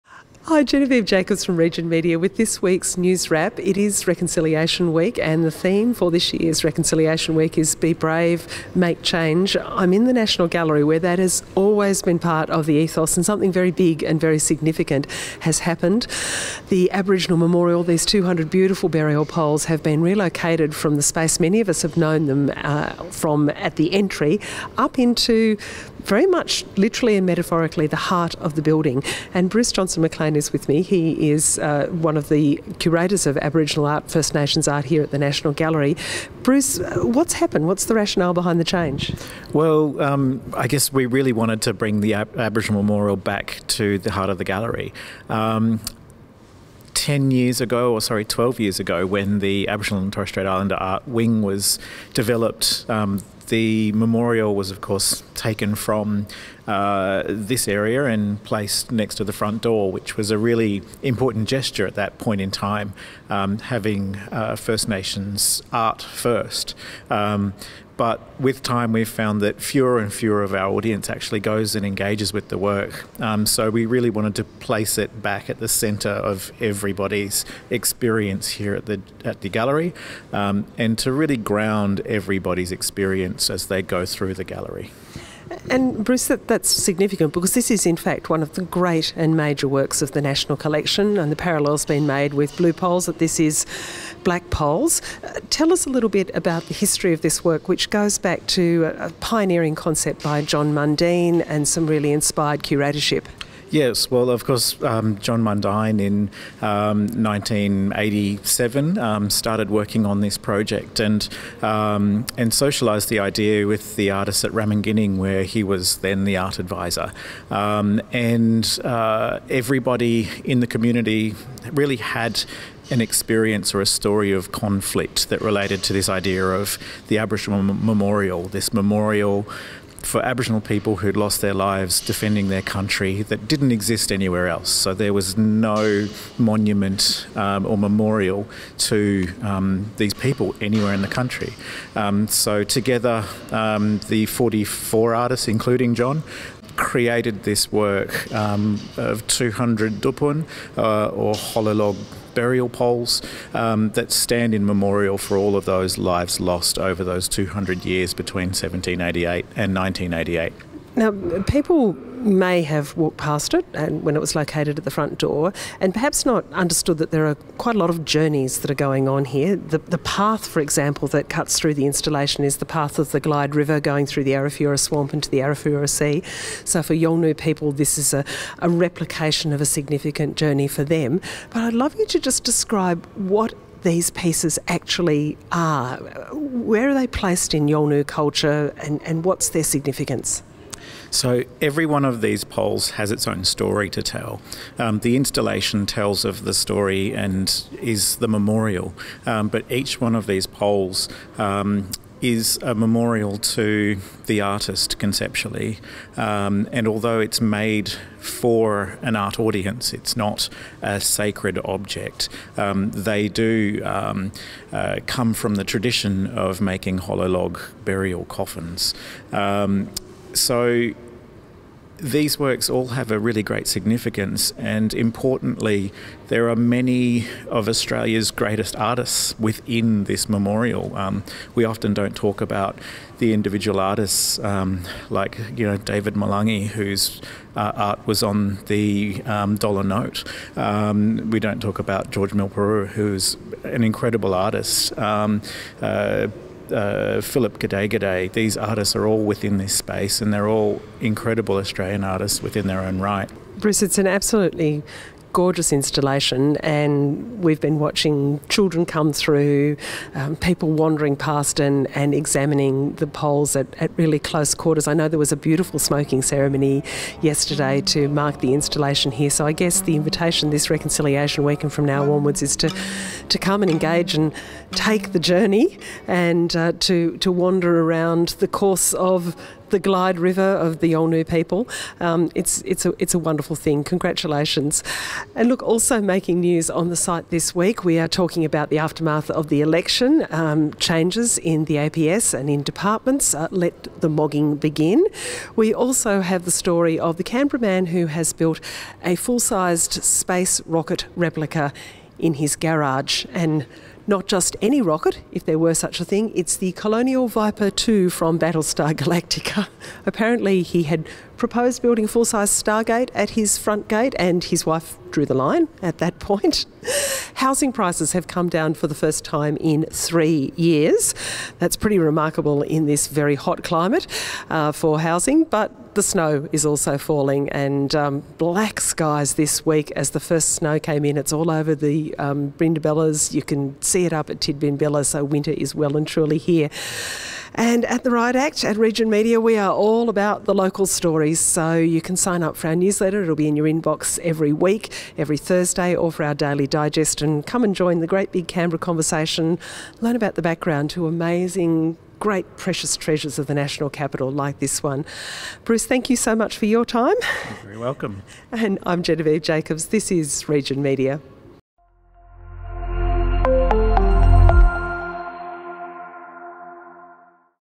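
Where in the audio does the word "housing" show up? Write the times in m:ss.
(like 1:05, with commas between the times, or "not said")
5:17, 5:25.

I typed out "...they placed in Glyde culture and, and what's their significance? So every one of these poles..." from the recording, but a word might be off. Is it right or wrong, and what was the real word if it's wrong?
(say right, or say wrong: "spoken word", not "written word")
wrong: "Yolngu", not "Glyde".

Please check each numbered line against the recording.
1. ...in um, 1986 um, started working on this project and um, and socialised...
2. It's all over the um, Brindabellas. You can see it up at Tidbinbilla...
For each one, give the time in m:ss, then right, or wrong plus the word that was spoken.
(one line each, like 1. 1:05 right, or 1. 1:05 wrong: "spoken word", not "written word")
1. 1:46 wrong: "1987", not "1986"
2. 5:31 right.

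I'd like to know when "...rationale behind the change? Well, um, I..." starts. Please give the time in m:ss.
0:37.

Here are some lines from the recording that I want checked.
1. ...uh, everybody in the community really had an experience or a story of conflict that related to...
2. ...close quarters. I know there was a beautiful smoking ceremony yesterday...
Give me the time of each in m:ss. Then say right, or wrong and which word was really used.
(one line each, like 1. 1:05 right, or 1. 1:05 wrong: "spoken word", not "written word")
1. 1:58 right
2. 4:24 right.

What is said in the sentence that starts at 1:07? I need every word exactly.
Um, but with time we've found that fewer and fewer of our audience actually goes and engages with the work.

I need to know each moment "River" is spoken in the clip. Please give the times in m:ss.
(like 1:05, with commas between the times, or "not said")
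2:53, 4:40.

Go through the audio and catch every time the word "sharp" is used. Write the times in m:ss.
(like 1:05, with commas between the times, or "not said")
not said.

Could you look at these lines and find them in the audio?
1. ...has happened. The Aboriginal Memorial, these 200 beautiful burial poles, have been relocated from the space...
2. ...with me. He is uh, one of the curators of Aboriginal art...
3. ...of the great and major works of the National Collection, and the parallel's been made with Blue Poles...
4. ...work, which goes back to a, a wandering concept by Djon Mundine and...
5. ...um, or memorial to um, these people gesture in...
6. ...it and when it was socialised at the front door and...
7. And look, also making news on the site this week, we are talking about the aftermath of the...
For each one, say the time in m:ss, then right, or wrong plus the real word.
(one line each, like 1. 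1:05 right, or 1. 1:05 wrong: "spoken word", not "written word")
1. 0:15 right
2. 0:30 right
3. 1:28 right
4. 1:37 wrong: "pioneering", not "wandering"
5. 2:17 wrong: "anywhere", not "gesture"
6. 2:43 wrong: "located", not "socialised"
7. 4:45 right.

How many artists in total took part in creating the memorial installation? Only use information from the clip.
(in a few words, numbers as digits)
44.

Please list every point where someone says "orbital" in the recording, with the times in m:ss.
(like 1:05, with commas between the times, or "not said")
not said.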